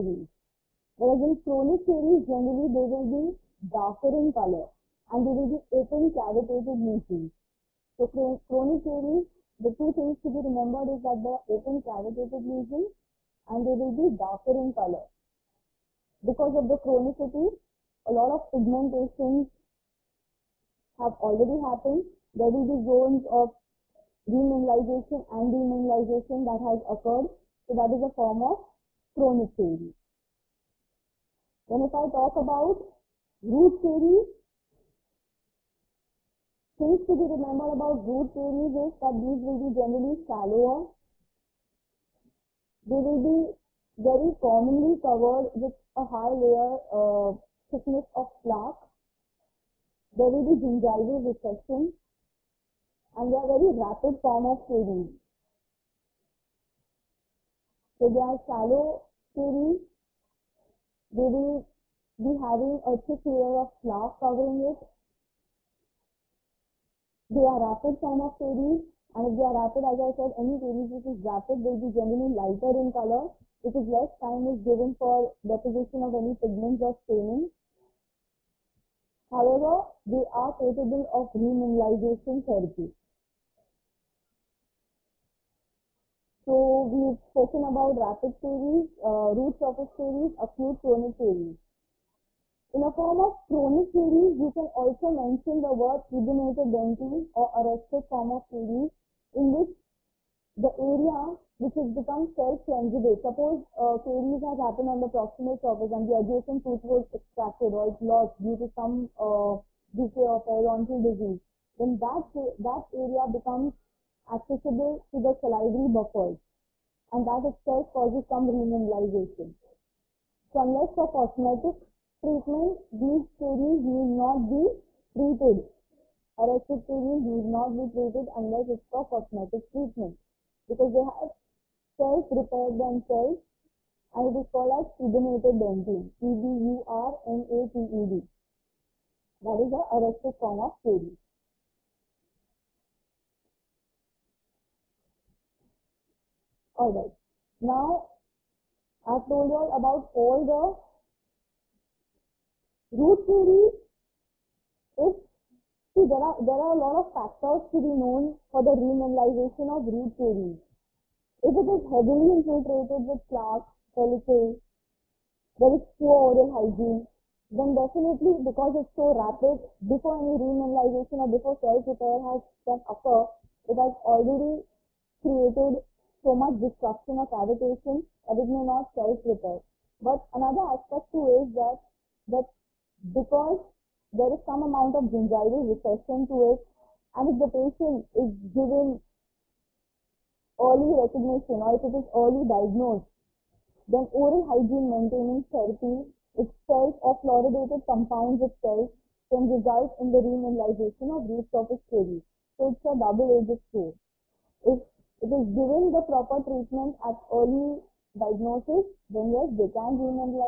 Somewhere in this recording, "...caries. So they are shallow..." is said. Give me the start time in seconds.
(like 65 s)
54 s.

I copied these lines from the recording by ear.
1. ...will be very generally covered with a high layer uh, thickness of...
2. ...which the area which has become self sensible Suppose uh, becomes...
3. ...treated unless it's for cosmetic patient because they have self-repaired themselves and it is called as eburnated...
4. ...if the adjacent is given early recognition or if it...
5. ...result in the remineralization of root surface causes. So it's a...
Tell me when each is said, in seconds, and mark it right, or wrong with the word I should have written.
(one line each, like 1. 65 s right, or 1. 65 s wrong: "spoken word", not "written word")
1. 43 s wrong: "commonly", not "generally"
2. 99 s wrong: "caries", not "becomes"
3. 127 s wrong: "treatment", not "patient"
4. 187 s wrong: "patient", not "adjacent"
5. 199 s wrong: "caries", not "causes".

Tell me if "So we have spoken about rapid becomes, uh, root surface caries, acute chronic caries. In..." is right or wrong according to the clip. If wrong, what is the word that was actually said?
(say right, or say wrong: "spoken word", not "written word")
wrong: "caries", not "becomes".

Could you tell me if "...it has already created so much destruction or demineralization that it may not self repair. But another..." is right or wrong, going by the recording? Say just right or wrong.
wrong.